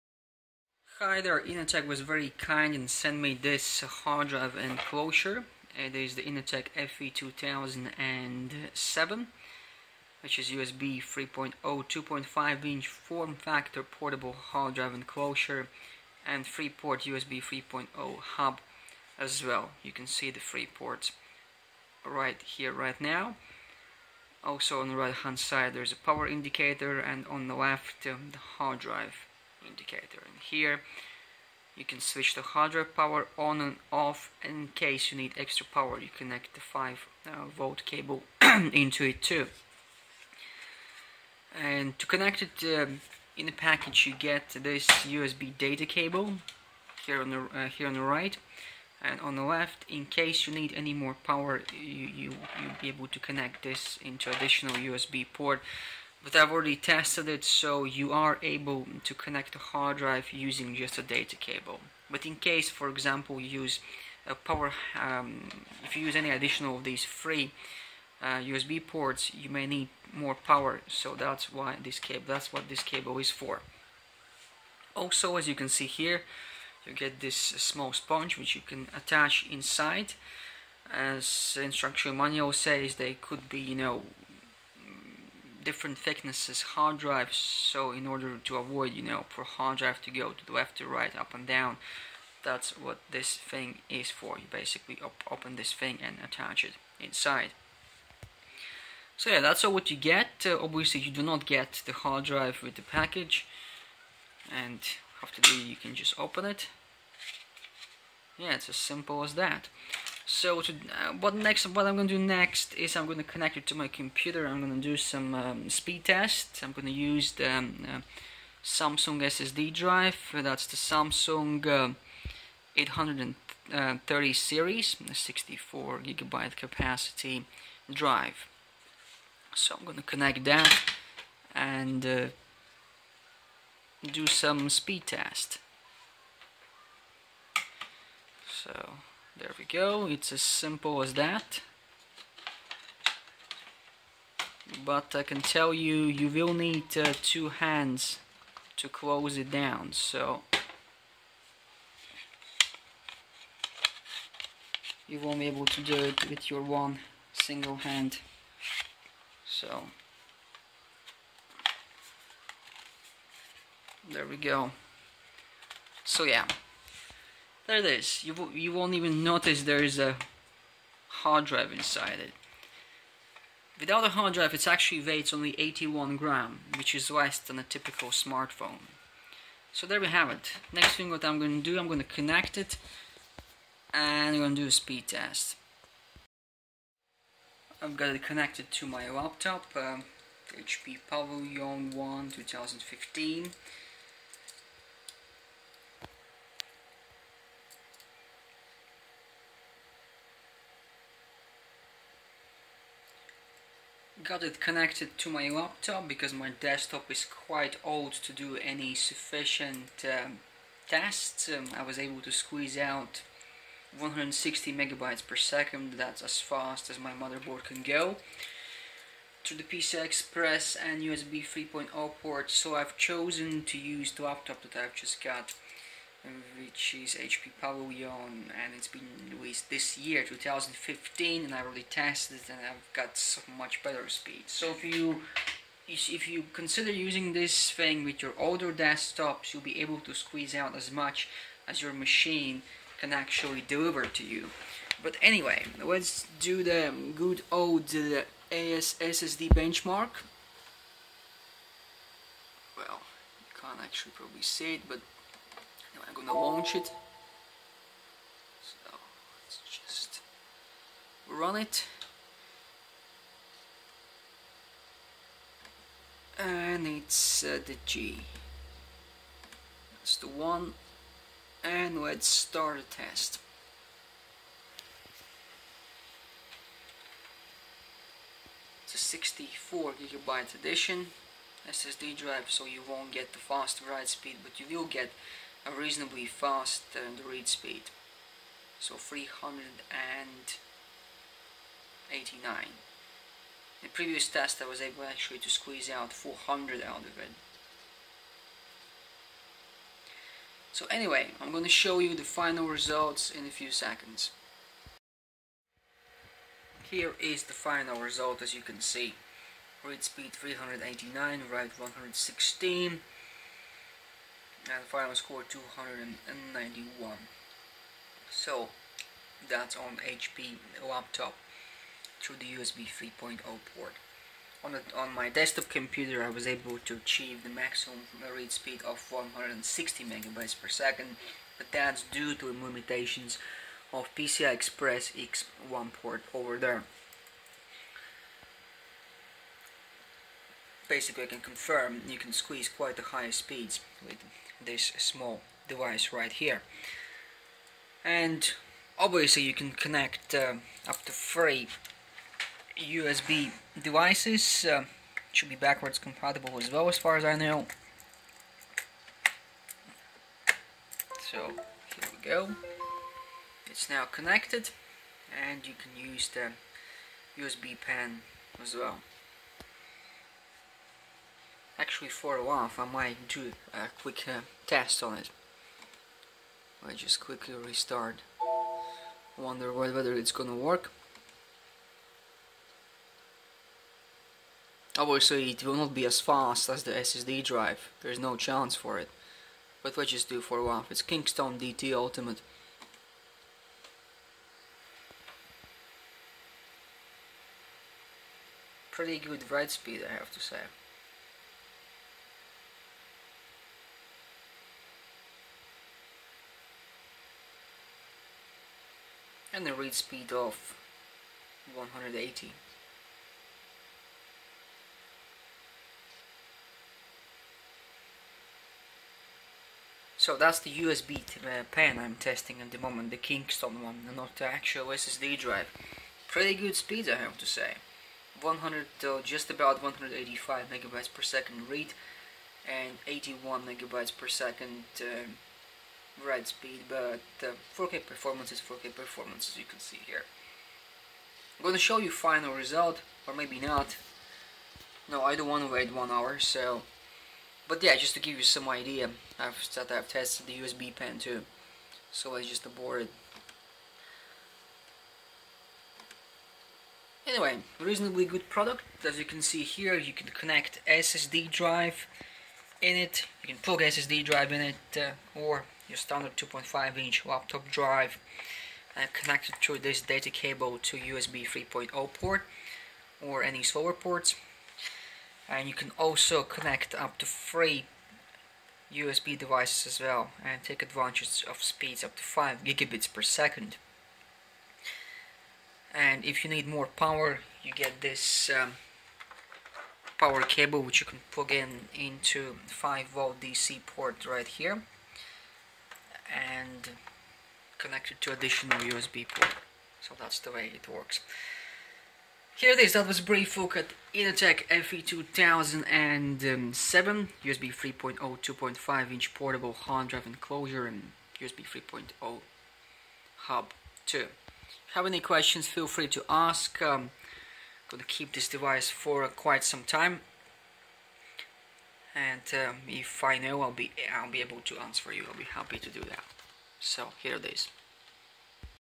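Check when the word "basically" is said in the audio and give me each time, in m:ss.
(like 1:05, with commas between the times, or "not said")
1:34, 5:40.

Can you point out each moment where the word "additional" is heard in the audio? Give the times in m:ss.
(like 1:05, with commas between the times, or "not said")
0:54, 1:06, 8:18.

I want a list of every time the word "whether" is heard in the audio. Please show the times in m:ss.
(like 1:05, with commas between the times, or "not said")
6:19.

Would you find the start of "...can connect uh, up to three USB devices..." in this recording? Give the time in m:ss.
5:49.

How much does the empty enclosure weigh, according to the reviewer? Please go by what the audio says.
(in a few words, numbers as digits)
81 grams.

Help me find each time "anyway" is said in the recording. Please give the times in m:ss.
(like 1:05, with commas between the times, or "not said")
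4:05, 5:00, 7:37.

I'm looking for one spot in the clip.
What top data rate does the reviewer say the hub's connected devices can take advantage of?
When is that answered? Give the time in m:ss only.
8:02.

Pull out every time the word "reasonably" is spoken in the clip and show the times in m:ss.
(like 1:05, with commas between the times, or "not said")
4:45, 7:37.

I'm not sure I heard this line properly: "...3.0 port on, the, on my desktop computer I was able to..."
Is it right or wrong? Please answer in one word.
right.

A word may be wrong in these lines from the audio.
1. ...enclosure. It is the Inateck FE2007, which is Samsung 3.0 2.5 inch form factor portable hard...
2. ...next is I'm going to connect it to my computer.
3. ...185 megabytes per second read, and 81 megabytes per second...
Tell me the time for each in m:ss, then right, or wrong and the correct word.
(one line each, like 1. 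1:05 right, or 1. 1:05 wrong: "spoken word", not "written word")
1. 0:04 wrong: "USB", not "Samsung"
2. 1:52 right
3. 7:09 right.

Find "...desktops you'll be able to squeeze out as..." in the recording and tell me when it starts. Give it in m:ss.
3:58.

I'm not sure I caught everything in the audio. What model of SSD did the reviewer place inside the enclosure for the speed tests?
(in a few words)
Samsung 830 series.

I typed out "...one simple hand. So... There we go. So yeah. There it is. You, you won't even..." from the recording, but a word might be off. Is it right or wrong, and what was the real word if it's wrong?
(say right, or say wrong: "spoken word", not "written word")
wrong: "single", not "simple".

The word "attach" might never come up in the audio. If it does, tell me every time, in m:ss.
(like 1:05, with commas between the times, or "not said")
1:18, 1:36.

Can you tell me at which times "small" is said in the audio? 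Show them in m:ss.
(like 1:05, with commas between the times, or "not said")
1:17, 5:44.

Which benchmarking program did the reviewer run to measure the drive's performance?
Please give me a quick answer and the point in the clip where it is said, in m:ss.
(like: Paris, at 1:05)
AS SSD, at 4:08.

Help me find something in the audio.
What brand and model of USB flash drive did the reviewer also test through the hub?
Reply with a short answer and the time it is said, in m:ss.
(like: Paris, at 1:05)
Kingston DT Ultimate, at 6:31.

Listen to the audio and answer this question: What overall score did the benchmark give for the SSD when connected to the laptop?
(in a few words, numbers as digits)
291.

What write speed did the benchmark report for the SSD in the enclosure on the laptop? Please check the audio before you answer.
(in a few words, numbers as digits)
116.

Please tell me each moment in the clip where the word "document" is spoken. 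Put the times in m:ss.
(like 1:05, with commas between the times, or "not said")
not said.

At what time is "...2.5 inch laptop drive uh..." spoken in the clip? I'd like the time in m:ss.
7:46.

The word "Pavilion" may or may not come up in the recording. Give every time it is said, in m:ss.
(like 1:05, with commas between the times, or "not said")
3:11, 3:47.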